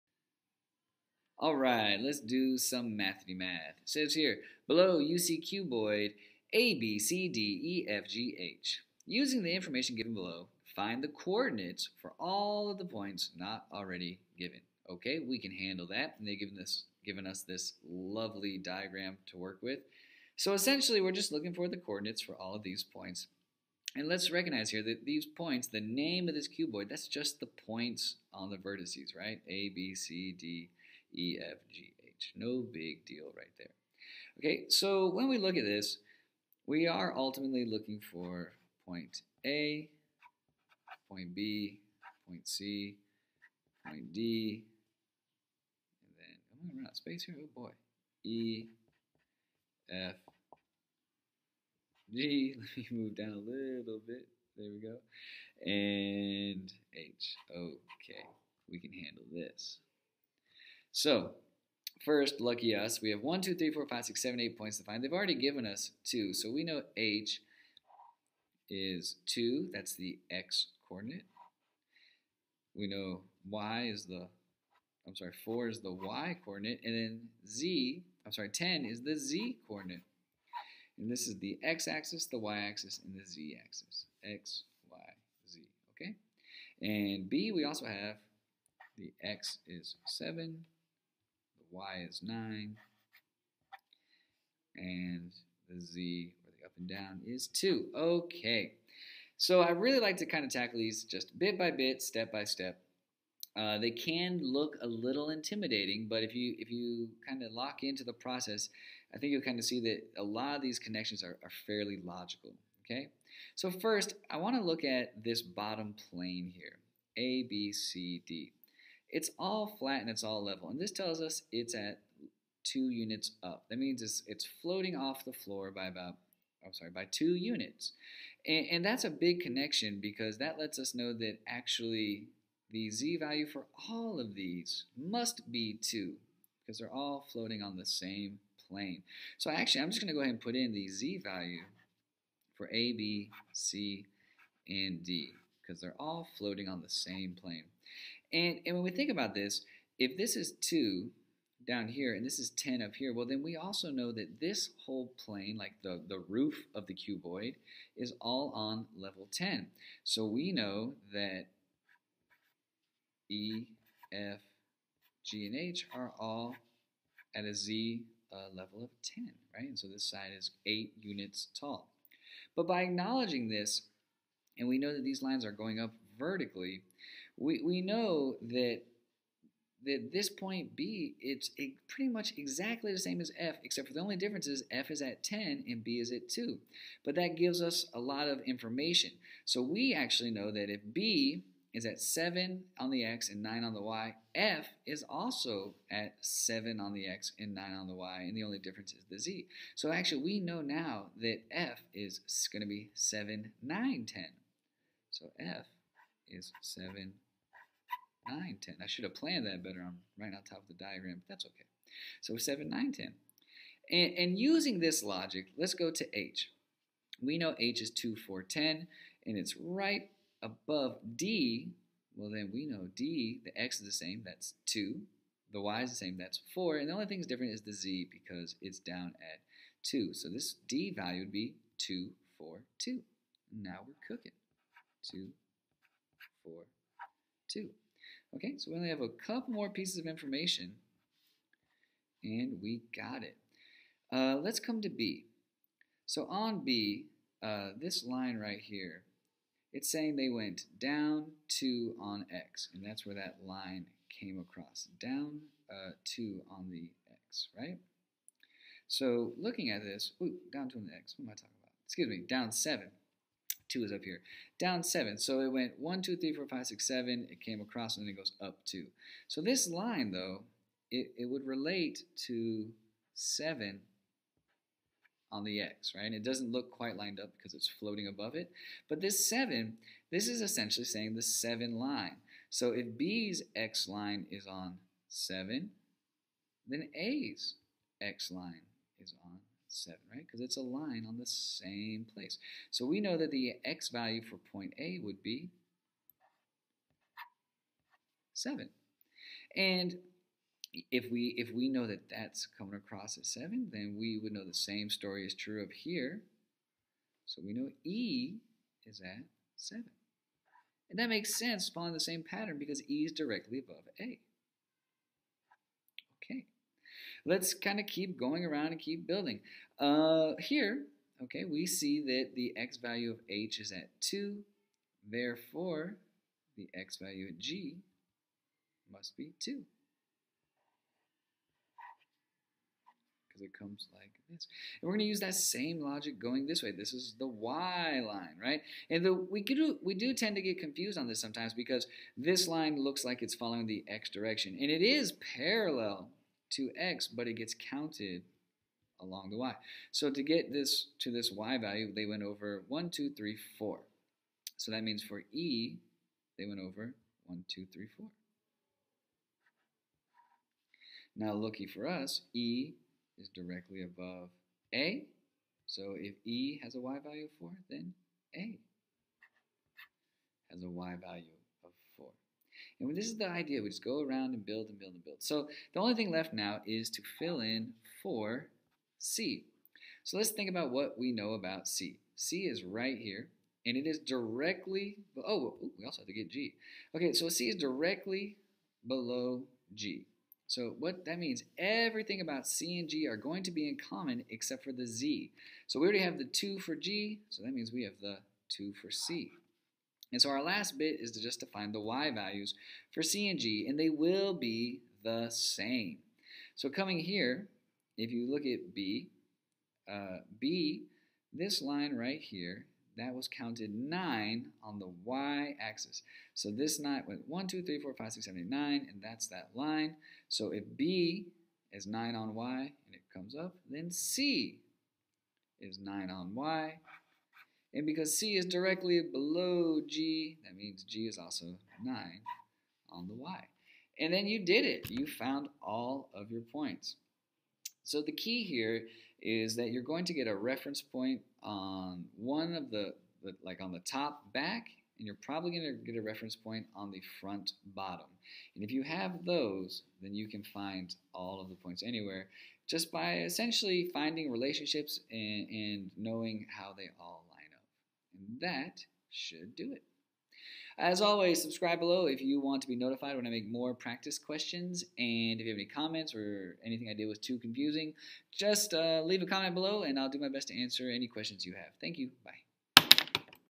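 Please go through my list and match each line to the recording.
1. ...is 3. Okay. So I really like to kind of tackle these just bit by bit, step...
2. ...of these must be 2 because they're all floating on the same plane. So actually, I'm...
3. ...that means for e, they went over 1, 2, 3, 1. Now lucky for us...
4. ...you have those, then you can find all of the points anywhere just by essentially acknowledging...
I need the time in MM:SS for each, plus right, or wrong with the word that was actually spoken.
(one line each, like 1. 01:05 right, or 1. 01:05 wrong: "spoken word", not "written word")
1. 01:37 wrong: "2", not "3"
2. 02:14 right
3. 05:54 wrong: "4", not "1"
4. 07:28 wrong: "finding", not "acknowledging".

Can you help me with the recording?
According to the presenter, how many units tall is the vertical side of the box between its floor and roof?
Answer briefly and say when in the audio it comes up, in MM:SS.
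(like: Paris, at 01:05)
8, at 02:50.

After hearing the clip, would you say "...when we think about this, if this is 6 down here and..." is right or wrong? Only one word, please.
wrong.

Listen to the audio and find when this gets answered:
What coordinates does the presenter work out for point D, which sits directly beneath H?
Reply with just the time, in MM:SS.
03:51.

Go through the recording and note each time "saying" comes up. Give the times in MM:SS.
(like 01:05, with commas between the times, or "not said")
04:09, 04:40.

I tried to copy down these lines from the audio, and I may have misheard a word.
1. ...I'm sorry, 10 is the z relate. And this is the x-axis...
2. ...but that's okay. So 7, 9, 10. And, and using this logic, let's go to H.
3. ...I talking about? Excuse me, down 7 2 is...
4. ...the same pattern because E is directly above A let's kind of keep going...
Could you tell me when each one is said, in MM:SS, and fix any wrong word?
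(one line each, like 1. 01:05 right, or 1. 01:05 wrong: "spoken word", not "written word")
1. 01:18 wrong: "coordinate", not "relate"
2. 03:31 right
3. 04:21 right
4. 05:11 right.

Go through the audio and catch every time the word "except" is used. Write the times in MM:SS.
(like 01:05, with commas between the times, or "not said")
03:03, 06:34.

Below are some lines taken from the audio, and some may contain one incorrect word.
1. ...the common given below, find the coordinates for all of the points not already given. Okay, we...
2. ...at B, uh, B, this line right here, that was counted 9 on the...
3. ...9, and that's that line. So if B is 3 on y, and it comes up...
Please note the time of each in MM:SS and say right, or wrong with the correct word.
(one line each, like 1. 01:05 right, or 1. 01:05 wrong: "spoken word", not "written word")
1. 00:09 wrong: "information", not "common"
2. 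06:48 right
3. 06:58 wrong: "9", not "3".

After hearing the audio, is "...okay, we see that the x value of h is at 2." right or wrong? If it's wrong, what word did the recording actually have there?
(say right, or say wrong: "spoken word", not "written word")
right.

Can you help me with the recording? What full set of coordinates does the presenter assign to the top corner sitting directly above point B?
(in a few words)
7, 9, 10.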